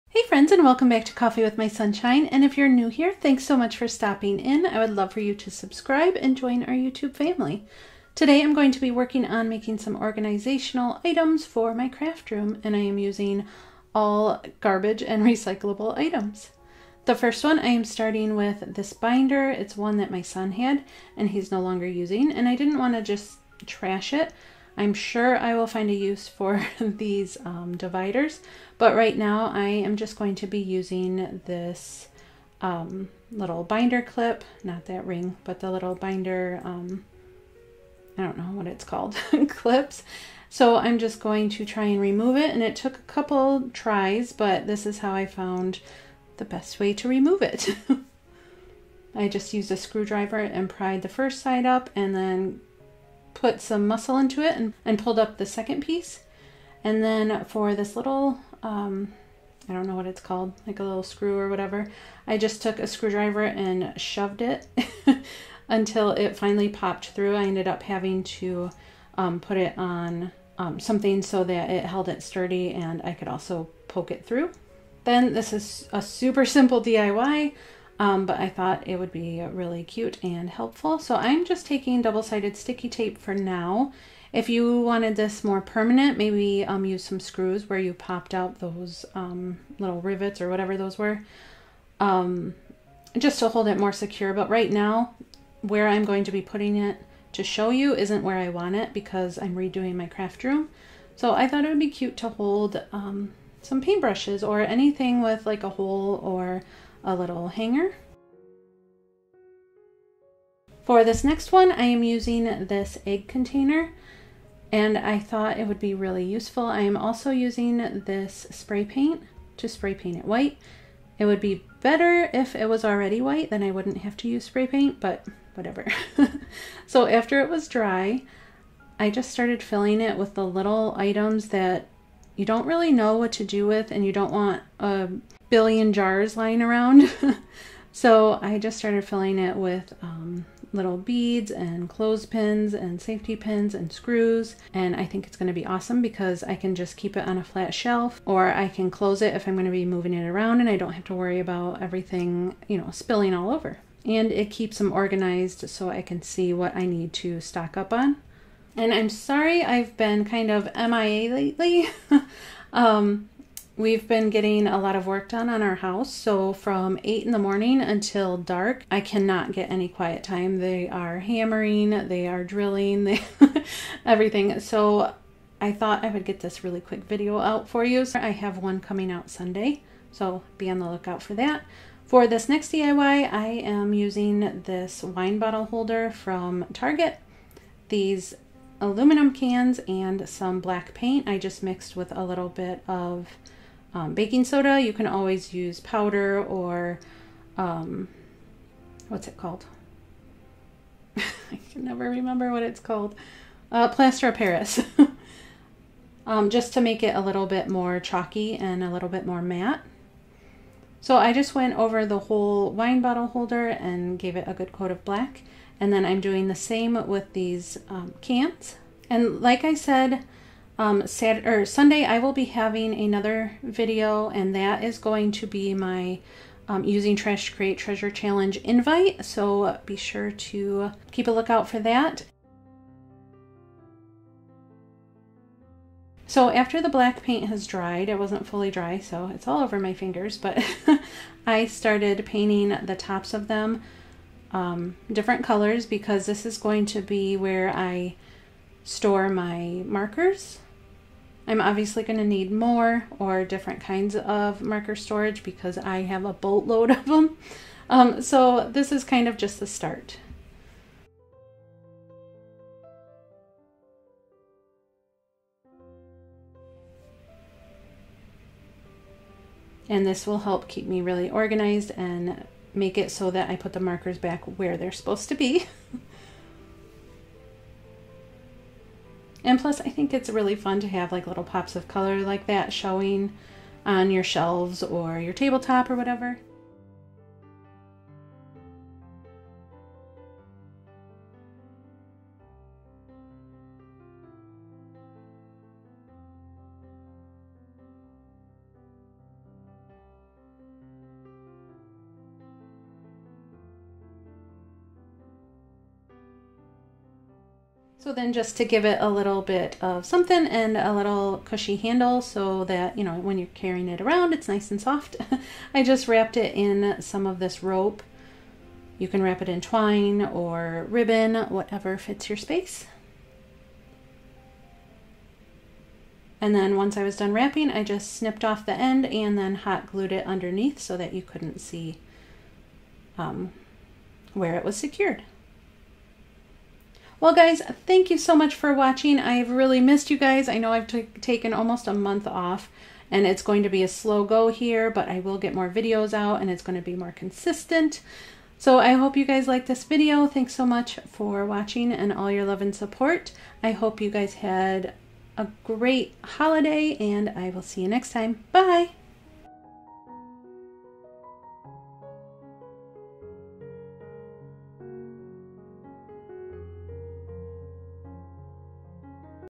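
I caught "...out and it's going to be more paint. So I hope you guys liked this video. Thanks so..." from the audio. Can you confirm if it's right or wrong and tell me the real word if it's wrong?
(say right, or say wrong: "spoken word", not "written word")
wrong: "consistent", not "paint".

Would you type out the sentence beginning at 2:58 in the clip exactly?
I have one coming out Sunday, so be on the lookout for that.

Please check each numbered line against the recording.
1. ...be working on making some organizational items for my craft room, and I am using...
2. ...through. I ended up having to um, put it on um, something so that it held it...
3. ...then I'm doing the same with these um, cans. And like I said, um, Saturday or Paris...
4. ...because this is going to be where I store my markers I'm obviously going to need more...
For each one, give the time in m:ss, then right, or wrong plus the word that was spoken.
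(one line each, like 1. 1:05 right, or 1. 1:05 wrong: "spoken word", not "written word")
1. 0:08 right
2. 1:07 right
3. 3:35 wrong: "Sunday", not "Paris"
4. 4:05 right.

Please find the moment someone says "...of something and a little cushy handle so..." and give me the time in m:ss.
5:09.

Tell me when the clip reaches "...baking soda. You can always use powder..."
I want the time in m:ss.
3:14.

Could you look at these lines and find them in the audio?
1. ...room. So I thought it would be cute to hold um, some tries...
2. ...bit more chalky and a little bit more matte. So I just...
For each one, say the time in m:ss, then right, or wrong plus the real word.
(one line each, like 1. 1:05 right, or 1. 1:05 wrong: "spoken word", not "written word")
1. 1:40 wrong: "paintbrushes", not "tries"
2. 3:27 right.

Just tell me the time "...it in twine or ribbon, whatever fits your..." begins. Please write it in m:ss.
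5:19.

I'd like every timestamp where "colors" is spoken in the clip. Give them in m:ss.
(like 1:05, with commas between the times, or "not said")
4:05, 4:41.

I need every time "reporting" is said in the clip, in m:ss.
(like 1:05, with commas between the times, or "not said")
not said.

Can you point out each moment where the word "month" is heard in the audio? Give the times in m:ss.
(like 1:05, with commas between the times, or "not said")
5:41.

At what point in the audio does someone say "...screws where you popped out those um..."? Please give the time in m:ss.
1:27.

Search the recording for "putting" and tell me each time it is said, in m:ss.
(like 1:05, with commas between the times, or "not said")
1:36.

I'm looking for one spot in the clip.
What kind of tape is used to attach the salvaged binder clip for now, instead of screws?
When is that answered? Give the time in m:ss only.
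1:22.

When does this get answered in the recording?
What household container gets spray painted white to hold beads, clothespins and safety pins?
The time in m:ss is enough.
1:53.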